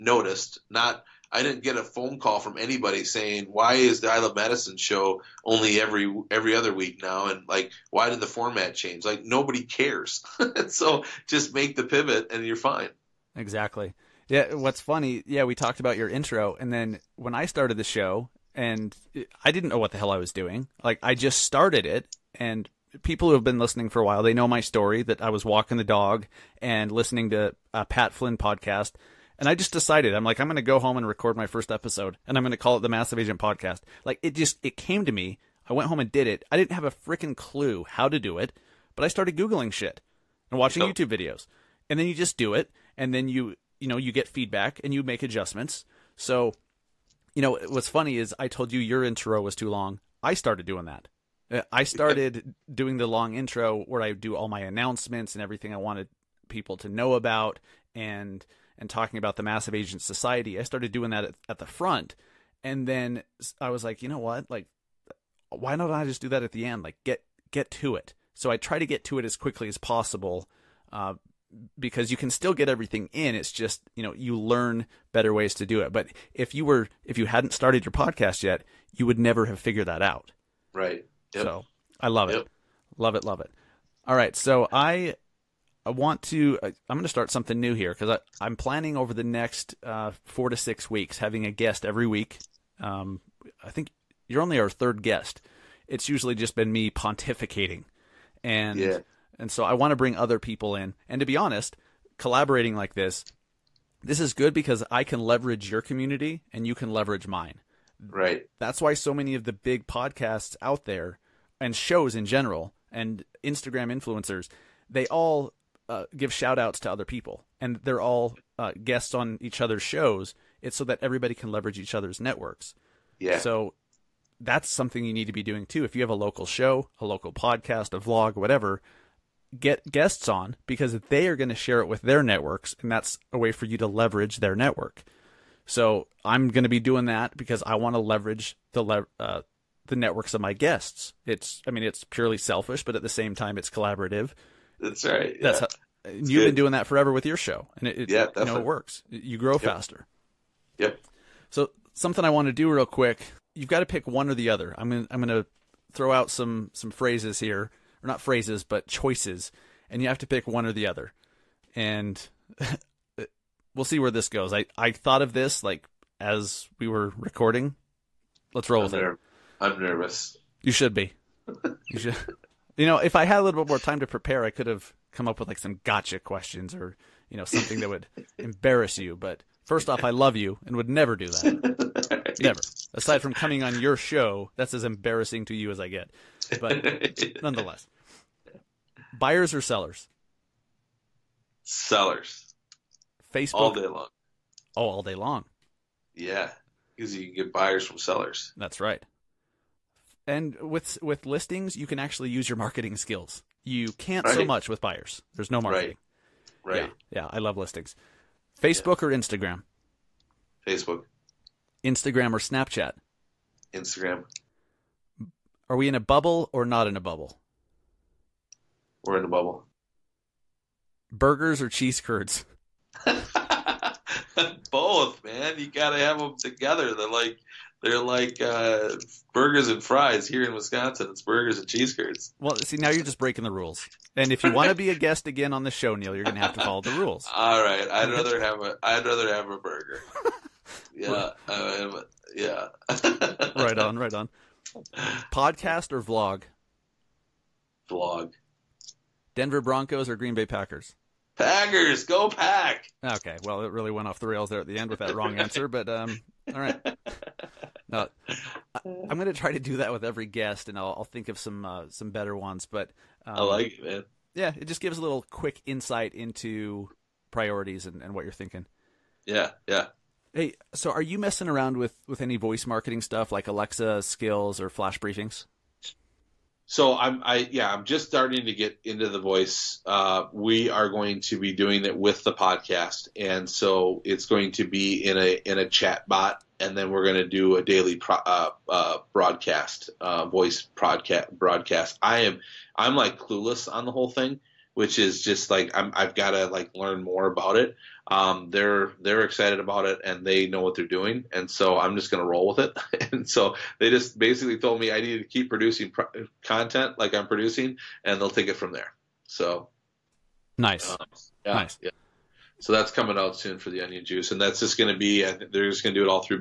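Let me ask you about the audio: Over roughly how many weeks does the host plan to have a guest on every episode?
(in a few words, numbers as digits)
4 to 6 weeks.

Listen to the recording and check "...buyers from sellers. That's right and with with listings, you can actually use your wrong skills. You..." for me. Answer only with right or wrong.
wrong.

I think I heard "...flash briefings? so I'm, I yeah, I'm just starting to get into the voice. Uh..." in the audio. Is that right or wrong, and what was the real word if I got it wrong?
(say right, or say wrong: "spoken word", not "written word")
right.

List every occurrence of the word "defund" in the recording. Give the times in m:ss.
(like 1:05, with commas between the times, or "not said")
not said.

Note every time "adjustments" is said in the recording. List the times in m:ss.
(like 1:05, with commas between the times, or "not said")
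0:45.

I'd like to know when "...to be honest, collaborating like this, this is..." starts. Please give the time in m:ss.
1:41.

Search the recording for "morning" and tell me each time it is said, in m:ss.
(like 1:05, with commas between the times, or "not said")
not said.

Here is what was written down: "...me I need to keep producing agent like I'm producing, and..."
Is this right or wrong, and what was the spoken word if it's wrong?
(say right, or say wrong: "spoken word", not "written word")
wrong: "content", not "agent".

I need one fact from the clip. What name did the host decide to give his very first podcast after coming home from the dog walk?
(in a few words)
Massive Agent Podcast.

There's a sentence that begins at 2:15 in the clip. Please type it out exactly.
So I'm going to be doing that because I want to leverage the le- uh, the networks of my guests.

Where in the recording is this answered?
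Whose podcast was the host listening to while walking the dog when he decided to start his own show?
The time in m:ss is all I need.
0:27.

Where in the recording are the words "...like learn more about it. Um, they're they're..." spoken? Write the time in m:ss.
4:56.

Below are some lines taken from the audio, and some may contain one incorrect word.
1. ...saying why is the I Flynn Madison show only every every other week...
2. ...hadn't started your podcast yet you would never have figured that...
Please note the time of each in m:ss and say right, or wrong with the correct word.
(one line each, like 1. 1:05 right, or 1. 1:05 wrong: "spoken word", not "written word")
1. 0:03 wrong: "Love", not "Flynn"
2. 1:17 right.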